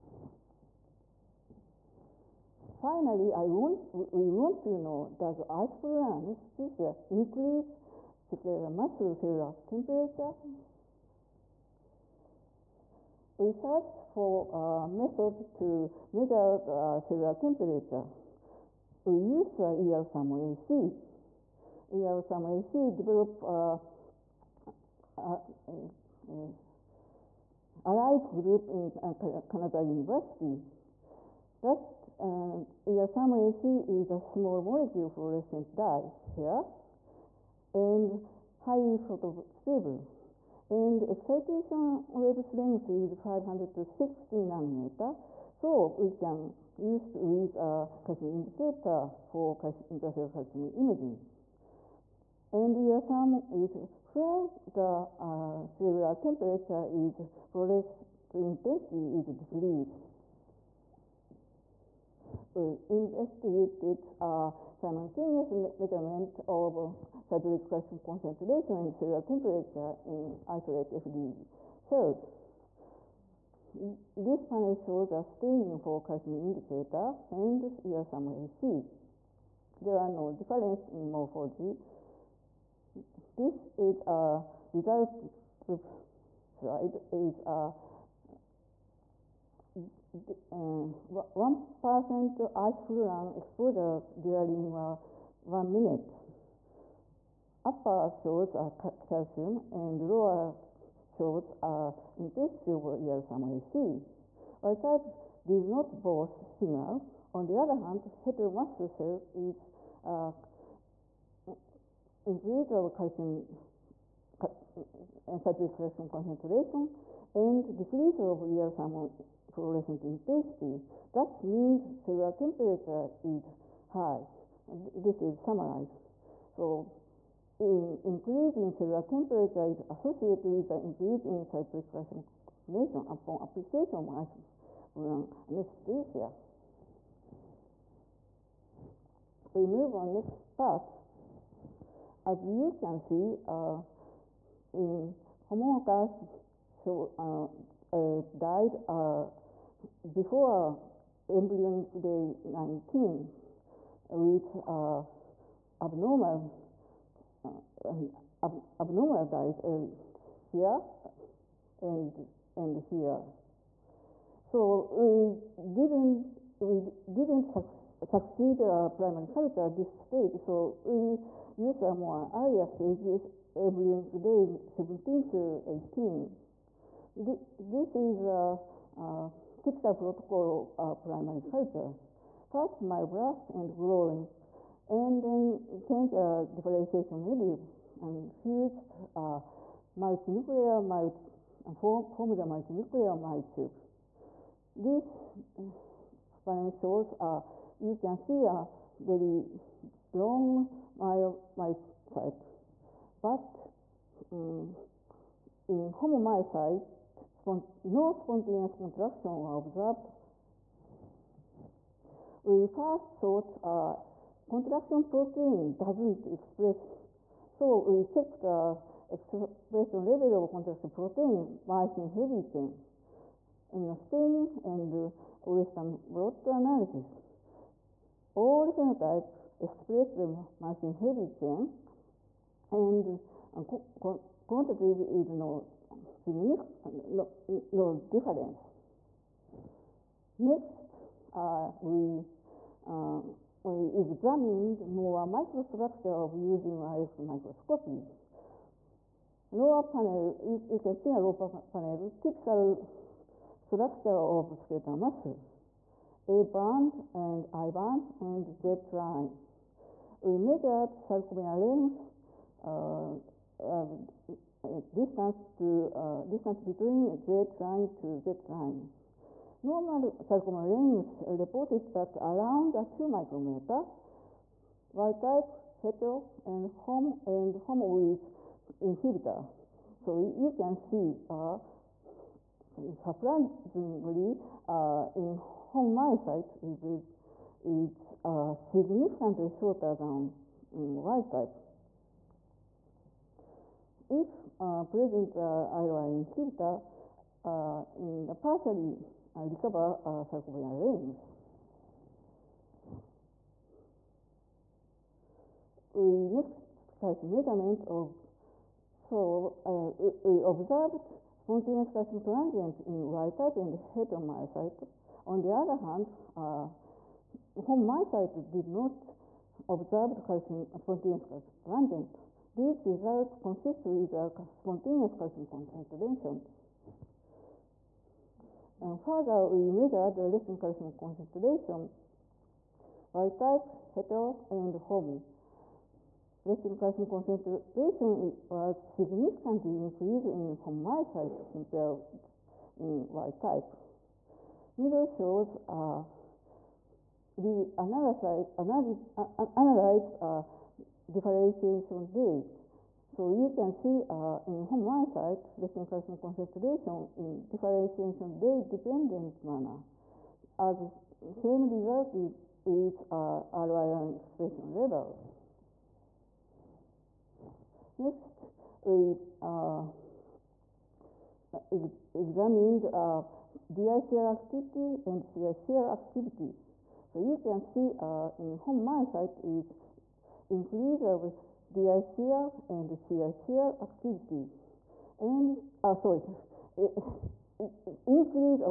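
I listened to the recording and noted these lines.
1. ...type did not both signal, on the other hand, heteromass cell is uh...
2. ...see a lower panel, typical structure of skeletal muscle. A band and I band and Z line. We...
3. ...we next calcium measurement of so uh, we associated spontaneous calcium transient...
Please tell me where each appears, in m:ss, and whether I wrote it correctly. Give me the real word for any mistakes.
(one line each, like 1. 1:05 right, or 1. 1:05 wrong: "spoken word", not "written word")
1. 1:44 right
2. 4:10 right
3. 5:05 wrong: "observed", not "associated".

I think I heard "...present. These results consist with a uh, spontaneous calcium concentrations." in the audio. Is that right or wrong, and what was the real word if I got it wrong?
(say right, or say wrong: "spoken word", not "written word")
wrong: "transient", not "present".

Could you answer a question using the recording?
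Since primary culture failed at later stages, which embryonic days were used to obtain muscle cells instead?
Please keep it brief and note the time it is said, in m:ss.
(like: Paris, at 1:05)
embryonic day 17 to 18, at 2:53.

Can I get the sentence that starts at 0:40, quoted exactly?
And excitation wavelength is 500 to 60 nanometer.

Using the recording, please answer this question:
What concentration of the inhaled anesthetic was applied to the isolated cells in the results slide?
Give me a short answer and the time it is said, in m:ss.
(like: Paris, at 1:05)
1%, at 1:30.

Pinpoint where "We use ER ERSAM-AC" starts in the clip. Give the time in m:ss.
0:19.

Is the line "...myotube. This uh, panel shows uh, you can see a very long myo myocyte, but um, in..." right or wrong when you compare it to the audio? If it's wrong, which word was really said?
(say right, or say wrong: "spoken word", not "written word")
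right.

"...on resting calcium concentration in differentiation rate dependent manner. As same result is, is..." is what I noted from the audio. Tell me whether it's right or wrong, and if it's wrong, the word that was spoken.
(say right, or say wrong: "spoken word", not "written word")
right.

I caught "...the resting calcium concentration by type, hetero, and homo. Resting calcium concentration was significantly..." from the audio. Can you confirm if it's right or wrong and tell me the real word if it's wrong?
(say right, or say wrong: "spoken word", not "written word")
right.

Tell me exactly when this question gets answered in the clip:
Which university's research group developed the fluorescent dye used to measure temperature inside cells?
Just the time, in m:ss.
0:28.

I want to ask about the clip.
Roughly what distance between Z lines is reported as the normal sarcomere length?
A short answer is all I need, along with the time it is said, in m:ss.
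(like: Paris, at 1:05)
around 2 micrometers, at 4:32.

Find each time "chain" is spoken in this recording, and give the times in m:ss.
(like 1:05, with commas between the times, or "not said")
3:42, 3:51.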